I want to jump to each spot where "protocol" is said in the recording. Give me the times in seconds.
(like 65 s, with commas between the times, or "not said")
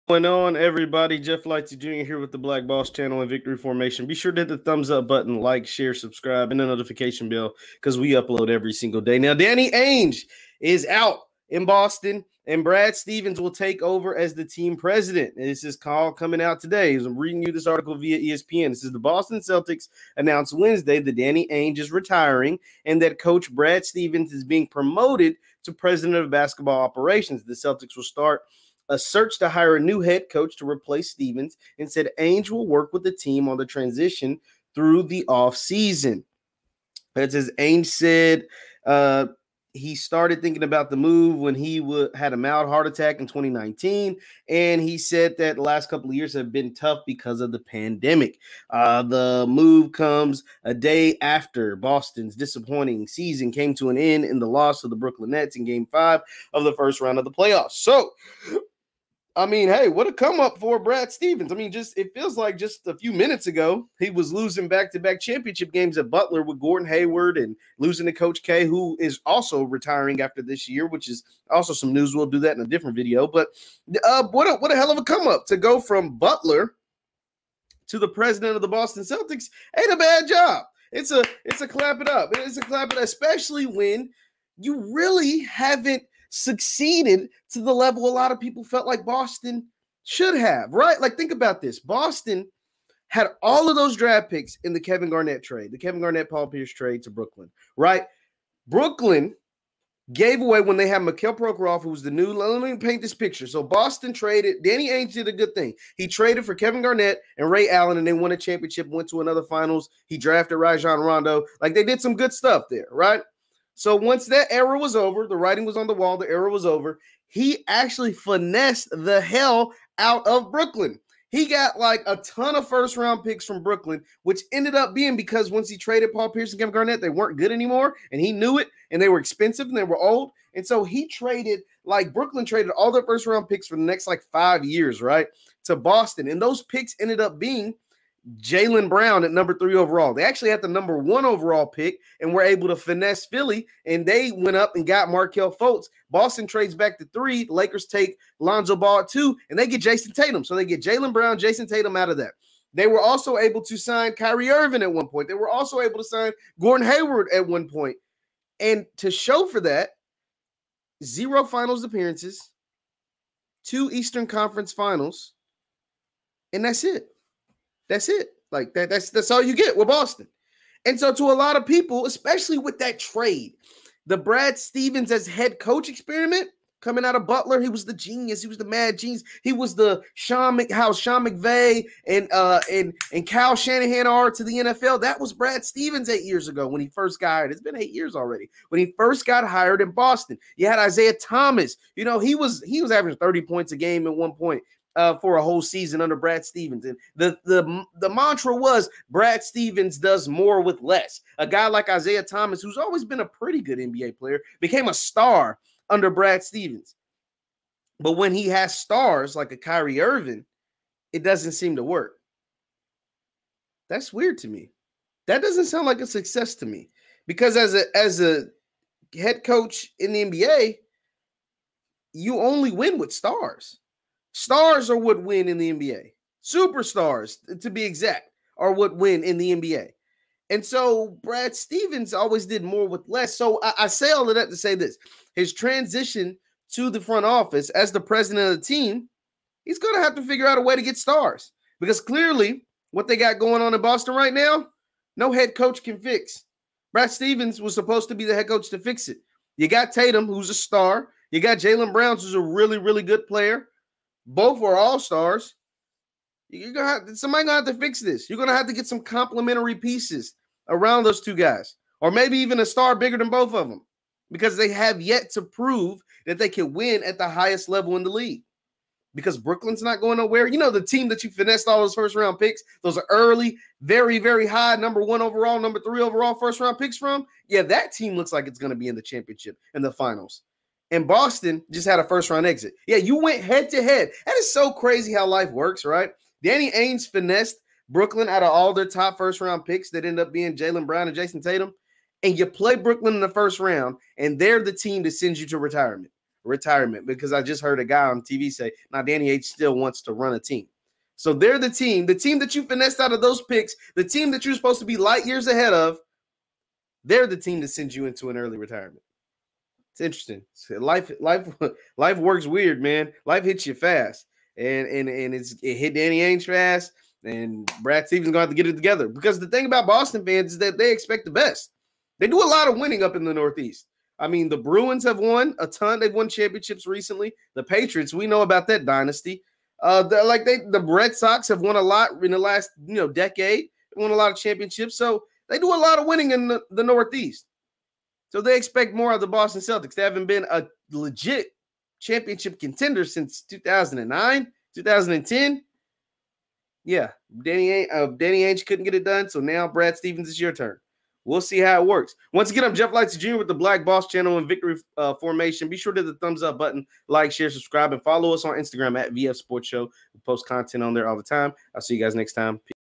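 not said.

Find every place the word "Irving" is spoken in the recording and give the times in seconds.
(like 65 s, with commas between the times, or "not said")
154 s, 210 s.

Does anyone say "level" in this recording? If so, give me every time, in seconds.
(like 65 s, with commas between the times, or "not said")
87 s, 267 s.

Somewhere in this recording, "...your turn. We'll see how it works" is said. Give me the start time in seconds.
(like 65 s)
350 s.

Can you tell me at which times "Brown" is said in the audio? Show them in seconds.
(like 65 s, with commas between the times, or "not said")
138 s, 151 s, 251 s, 290 s.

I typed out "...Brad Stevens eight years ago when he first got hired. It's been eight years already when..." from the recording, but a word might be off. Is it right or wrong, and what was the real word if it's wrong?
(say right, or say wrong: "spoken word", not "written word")
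right.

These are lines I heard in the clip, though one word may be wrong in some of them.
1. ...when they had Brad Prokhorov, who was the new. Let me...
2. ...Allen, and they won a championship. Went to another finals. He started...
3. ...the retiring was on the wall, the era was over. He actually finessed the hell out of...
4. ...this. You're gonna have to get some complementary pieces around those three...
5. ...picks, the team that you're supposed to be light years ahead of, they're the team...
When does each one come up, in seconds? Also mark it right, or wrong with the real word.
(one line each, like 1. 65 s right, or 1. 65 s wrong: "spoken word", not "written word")
1. 100 s wrong: "Mikel", not "Brad"
2. 107 s wrong: "drafted", not "started"
3. 115 s wrong: "writing", not "retiring"
4. 258 s wrong: "two", not "three"
5. 303 s right.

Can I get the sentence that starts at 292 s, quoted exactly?
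And you play Brooklyn in the first round, and they're the team that sends you to retirement.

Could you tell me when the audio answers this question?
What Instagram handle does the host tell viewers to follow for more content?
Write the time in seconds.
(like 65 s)
359 s.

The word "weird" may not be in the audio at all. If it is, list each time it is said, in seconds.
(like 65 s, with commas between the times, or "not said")
214 s, 312 s.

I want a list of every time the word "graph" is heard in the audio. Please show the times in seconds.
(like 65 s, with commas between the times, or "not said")
not said.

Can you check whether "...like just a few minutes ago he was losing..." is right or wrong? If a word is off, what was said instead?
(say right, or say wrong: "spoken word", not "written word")
right.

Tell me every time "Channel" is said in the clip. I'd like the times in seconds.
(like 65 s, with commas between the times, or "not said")
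2 s, 354 s.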